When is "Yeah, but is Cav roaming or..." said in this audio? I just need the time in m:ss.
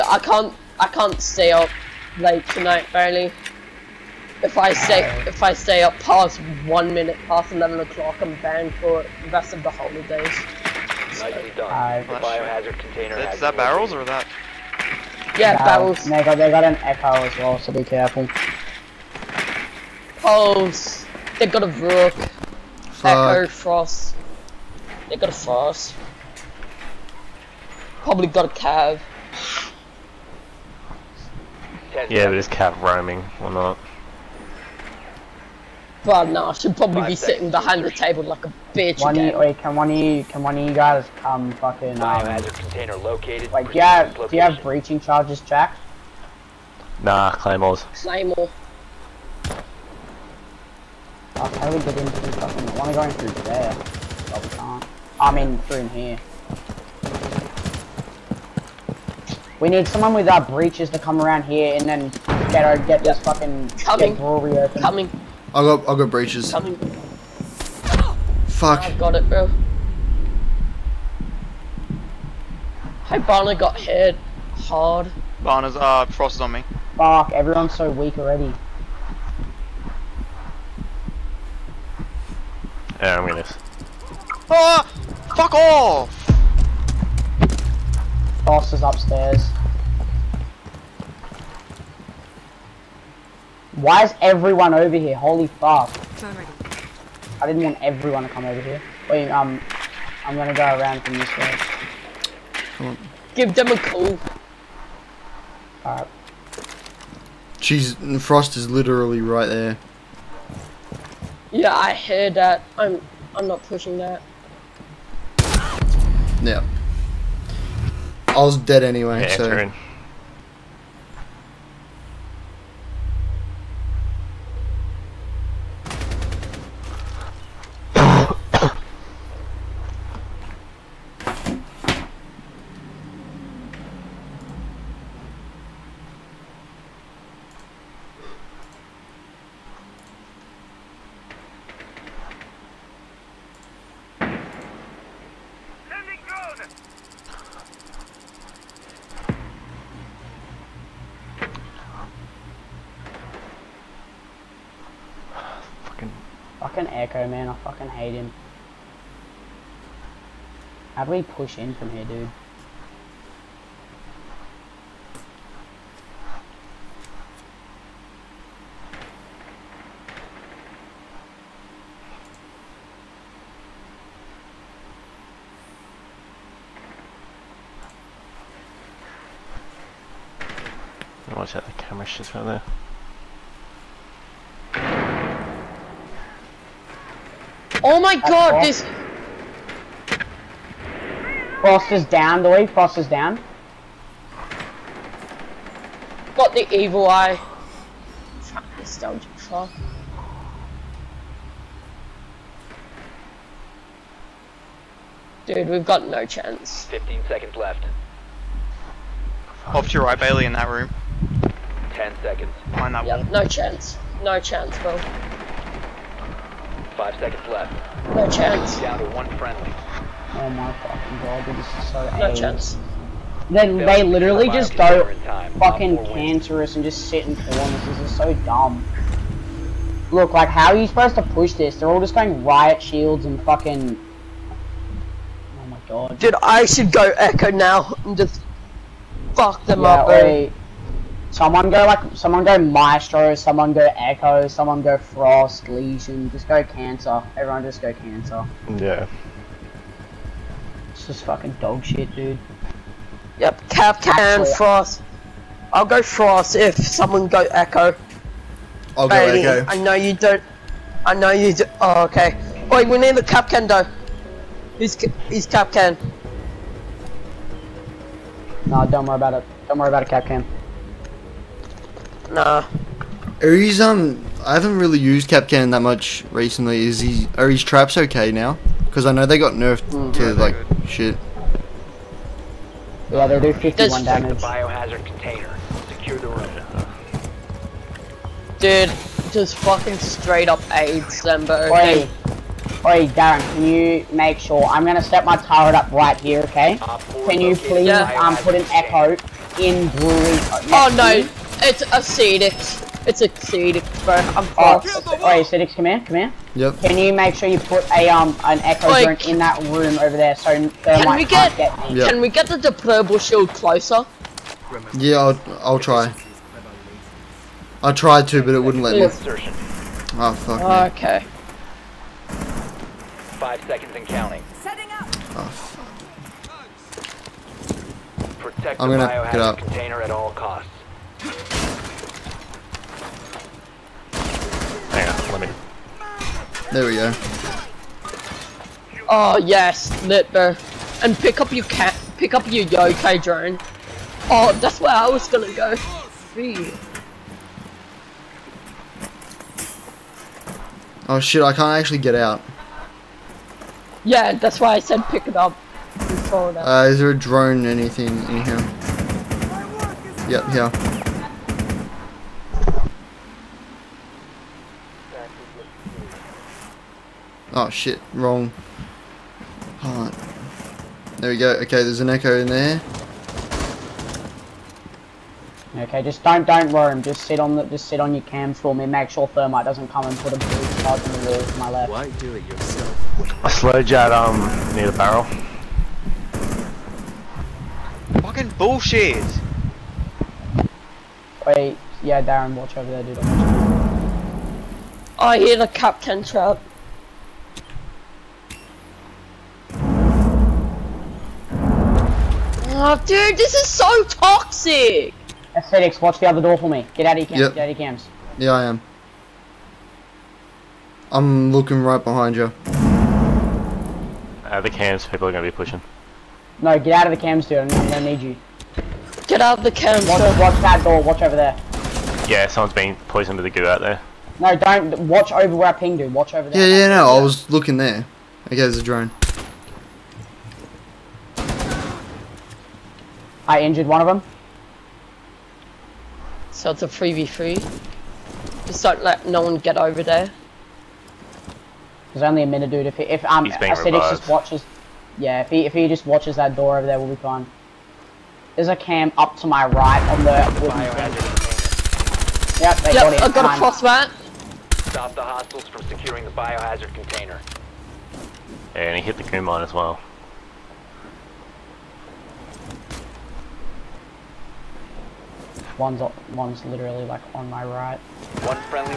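0:32.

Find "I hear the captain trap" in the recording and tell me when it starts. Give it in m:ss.
6:35.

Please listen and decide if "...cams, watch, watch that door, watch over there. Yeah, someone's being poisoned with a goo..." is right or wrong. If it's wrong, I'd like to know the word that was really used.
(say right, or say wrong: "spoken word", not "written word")
right.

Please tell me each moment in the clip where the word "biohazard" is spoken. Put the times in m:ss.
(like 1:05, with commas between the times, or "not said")
0:12, 4:44, 7:36.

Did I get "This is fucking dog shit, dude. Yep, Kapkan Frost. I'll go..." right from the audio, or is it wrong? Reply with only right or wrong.
right.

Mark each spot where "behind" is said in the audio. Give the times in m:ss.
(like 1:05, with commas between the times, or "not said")
0:37, 6:52.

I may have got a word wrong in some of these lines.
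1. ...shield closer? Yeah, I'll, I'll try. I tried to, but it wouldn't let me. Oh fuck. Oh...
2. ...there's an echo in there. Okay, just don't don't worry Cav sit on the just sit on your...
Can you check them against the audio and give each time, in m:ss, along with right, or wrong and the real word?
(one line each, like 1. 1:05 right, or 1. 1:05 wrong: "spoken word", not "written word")
1. 5:13 right
2. 6:11 wrong: "Just", not "Cav".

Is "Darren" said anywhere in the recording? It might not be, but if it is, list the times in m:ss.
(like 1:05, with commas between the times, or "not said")
4:53, 6:32.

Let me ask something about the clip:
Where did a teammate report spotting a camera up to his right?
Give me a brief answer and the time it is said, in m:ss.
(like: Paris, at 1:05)
On the wooden fence, at 7:30.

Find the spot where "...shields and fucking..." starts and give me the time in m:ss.
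3:52.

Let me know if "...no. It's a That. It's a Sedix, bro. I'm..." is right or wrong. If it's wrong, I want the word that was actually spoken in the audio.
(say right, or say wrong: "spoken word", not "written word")
wrong: "Sedix", not "That".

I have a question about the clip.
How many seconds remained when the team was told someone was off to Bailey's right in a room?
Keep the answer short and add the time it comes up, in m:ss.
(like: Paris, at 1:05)
15, at 3:26.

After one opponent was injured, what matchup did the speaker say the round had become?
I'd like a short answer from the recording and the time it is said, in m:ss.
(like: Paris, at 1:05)
3v3, at 7:16.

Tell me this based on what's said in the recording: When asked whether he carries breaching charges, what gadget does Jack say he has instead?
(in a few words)
Claymores.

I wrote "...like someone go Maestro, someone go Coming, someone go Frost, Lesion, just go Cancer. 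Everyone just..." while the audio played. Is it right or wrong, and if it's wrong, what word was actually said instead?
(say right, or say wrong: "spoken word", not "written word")
wrong: "Echo", not "Coming".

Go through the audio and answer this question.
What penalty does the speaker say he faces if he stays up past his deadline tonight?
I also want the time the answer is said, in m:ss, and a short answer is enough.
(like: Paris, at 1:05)
Banned for the rest of the holidays, at 0:08.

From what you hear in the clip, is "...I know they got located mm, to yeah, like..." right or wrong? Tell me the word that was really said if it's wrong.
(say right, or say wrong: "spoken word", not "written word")
wrong: "nerfed", not "located".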